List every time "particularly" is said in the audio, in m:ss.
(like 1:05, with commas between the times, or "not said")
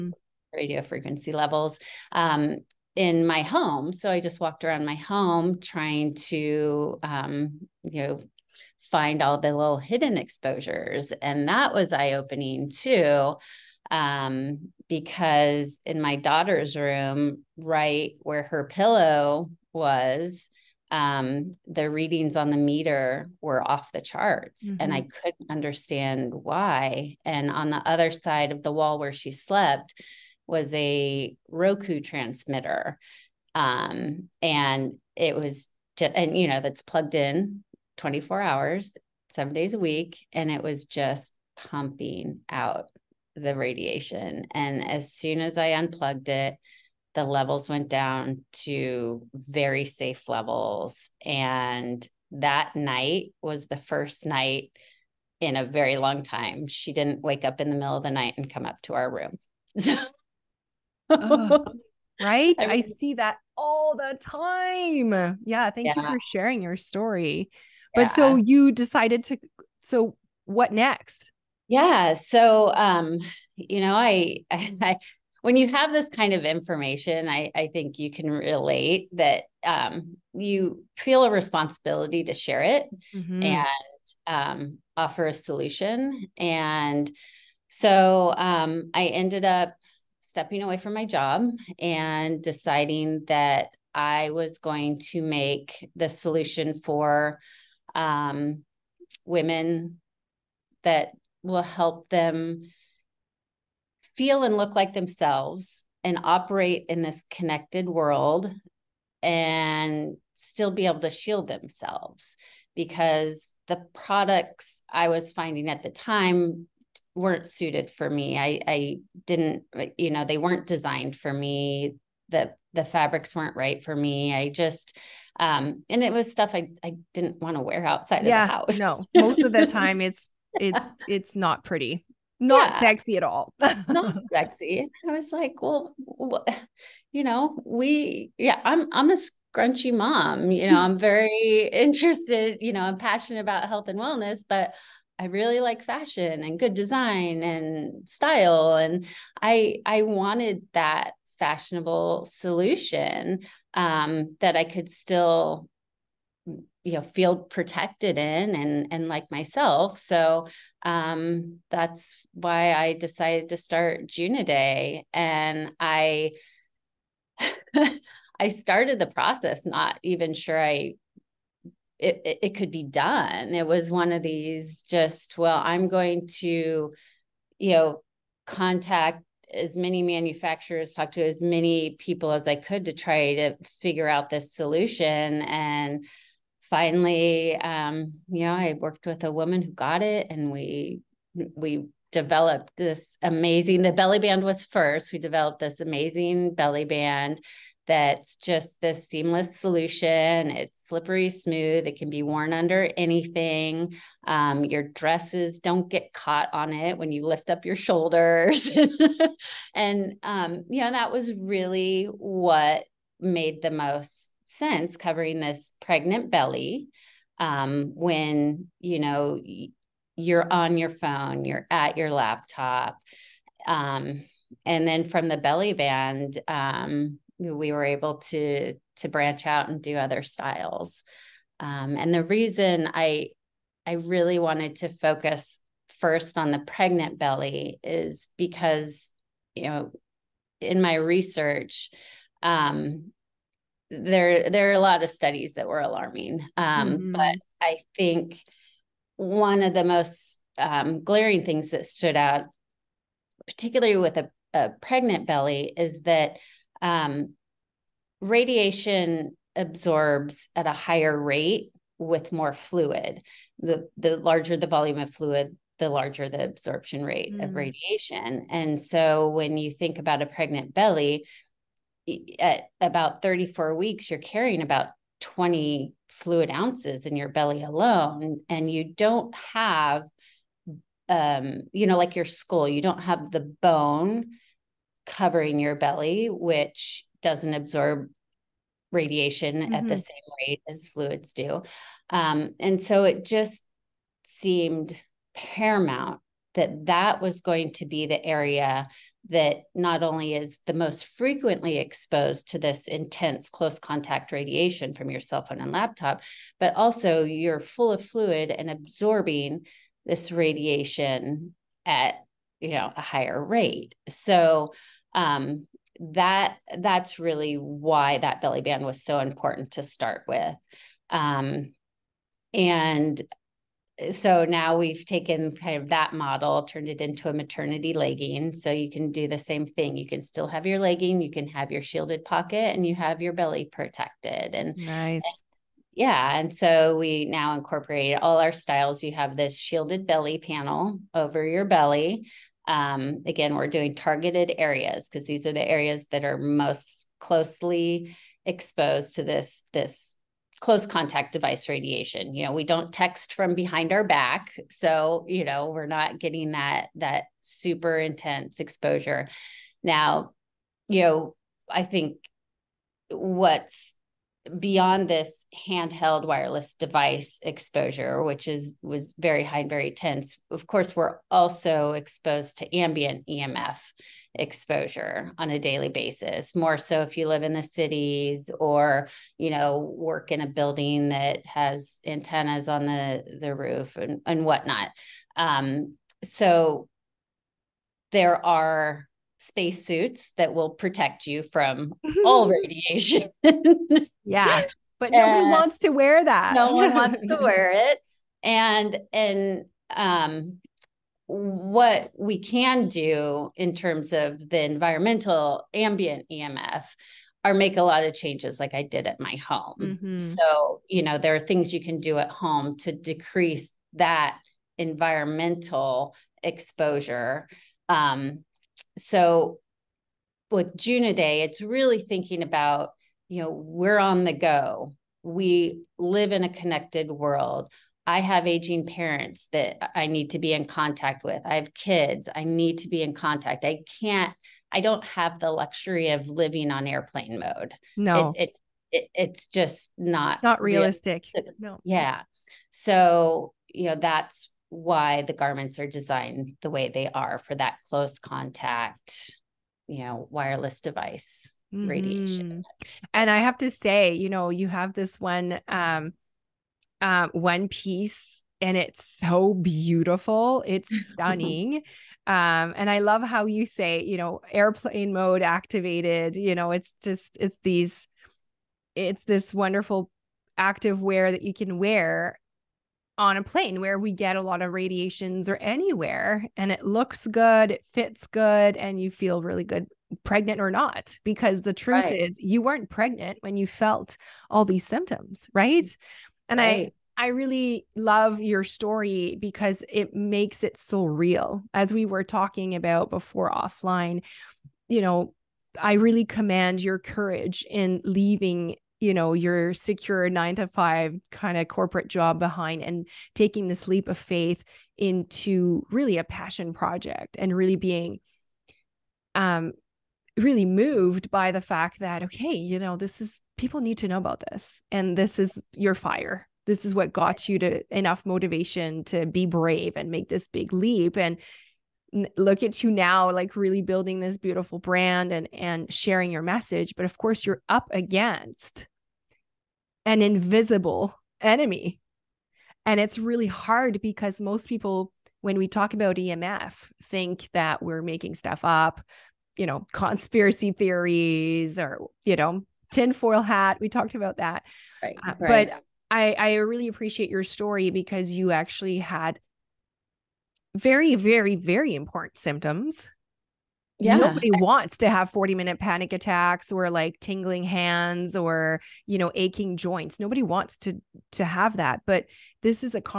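4:13.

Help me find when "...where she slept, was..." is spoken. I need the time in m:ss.
0:28.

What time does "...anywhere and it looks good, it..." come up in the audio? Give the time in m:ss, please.
7:55.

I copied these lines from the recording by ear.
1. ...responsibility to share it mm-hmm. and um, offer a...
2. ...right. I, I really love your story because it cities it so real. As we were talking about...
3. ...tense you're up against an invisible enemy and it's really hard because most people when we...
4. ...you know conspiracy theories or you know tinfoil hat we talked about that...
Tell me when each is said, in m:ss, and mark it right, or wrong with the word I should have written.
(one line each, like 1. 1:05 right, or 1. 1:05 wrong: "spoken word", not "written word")
1. 1:21 right
2. 8:06 wrong: "makes", not "cities"
3. 8:47 wrong: "course", not "tense"
4. 8:59 right.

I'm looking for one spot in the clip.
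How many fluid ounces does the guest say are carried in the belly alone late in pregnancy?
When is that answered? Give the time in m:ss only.
4:35.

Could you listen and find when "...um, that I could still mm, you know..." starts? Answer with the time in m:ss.
2:33.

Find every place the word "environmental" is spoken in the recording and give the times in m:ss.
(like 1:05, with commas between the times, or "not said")
6:44, 6:54.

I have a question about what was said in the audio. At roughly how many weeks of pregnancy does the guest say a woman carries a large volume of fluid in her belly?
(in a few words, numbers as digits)
34 weeks.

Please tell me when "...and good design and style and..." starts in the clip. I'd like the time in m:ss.
2:26.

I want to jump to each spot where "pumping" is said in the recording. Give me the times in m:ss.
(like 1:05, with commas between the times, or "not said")
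0:41.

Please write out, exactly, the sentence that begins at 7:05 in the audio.
We live in a connected world.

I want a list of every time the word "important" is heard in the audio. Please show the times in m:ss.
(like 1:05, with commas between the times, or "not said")
5:19, 9:11.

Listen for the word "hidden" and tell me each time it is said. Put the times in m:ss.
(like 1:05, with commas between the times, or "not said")
0:09.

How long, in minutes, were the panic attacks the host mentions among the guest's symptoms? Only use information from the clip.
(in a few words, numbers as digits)
40 minutes.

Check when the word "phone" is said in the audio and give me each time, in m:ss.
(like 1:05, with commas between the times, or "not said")
3:40, 5:05.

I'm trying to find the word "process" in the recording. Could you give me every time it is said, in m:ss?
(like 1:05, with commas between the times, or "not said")
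2:49.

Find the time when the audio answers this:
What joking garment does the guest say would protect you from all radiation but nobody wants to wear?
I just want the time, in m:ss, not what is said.
6:29.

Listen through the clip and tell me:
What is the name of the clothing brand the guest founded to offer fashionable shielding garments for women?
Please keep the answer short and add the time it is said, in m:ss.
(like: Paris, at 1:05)
Juunaday, at 2:44.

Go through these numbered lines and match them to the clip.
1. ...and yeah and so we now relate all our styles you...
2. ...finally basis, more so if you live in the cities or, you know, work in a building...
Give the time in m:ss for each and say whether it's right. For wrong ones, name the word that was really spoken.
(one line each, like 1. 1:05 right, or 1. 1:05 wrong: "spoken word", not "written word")
1. 5:35 wrong: "incorporate", not "relate"
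2. 6:15 wrong: "daily", not "finally".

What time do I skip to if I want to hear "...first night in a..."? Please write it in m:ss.
0:53.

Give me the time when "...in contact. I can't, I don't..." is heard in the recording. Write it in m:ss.
7:13.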